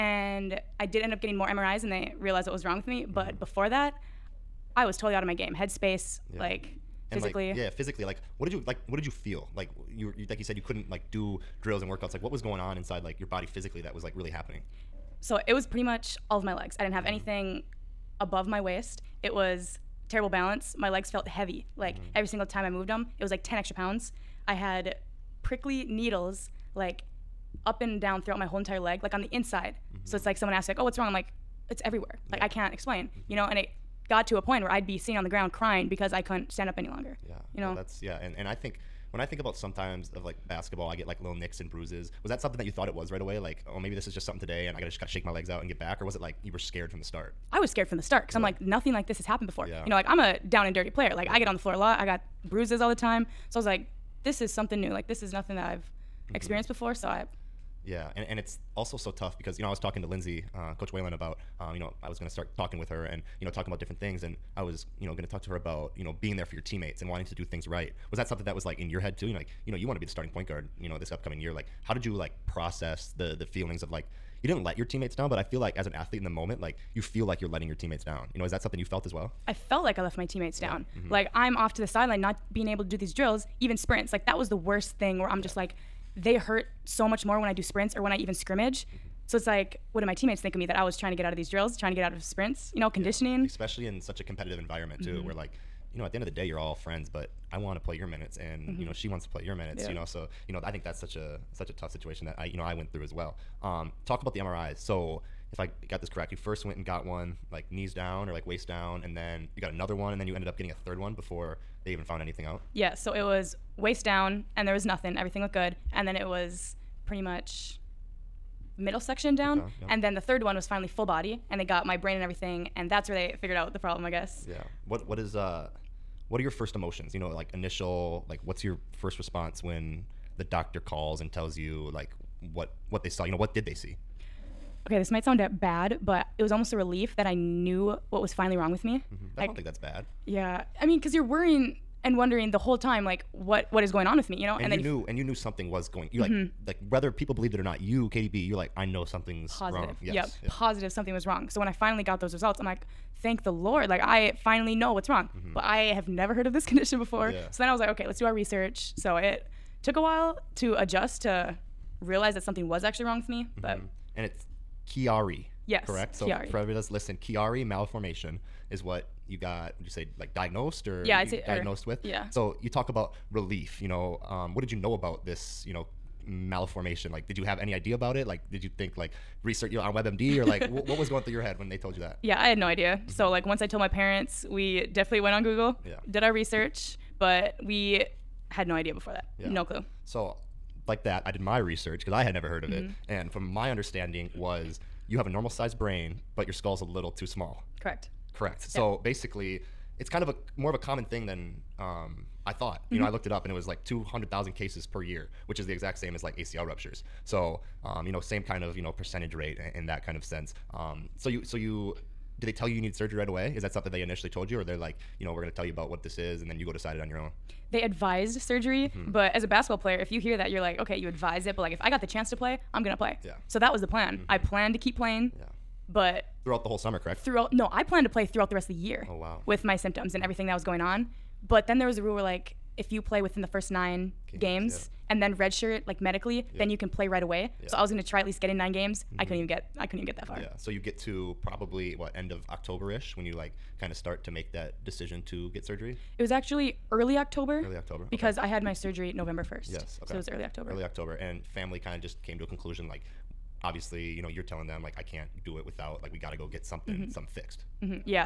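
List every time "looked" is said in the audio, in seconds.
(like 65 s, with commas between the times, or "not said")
115 s, 203 s.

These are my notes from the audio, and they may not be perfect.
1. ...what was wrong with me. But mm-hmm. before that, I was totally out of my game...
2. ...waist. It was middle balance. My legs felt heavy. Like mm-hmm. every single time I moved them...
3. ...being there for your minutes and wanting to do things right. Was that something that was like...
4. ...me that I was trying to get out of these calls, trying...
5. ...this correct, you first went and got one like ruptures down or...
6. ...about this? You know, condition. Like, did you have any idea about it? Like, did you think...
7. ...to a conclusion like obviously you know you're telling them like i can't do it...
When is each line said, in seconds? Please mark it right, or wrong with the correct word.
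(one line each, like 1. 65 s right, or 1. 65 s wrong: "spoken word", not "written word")
1. 2 s right
2. 18 s wrong: "terrible", not "middle"
3. 66 s wrong: "teammates", not "minutes"
4. 90 s wrong: "drills", not "calls"
5. 105 s wrong: "knees", not "ruptures"
6. 174 s wrong: "malformation", not "condition"
7. 252 s right.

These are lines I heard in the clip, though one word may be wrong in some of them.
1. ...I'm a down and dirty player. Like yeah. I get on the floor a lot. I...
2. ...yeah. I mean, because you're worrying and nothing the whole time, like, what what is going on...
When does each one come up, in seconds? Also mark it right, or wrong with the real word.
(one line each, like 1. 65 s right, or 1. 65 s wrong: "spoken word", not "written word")
1. 50 s right
2. 140 s wrong: "wondering", not "nothing".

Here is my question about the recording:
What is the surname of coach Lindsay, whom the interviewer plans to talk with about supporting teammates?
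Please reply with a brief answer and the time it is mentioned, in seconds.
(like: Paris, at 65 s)
Whalen, at 60 s.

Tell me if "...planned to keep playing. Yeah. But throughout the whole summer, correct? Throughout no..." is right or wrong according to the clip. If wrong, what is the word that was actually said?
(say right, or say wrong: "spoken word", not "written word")
right.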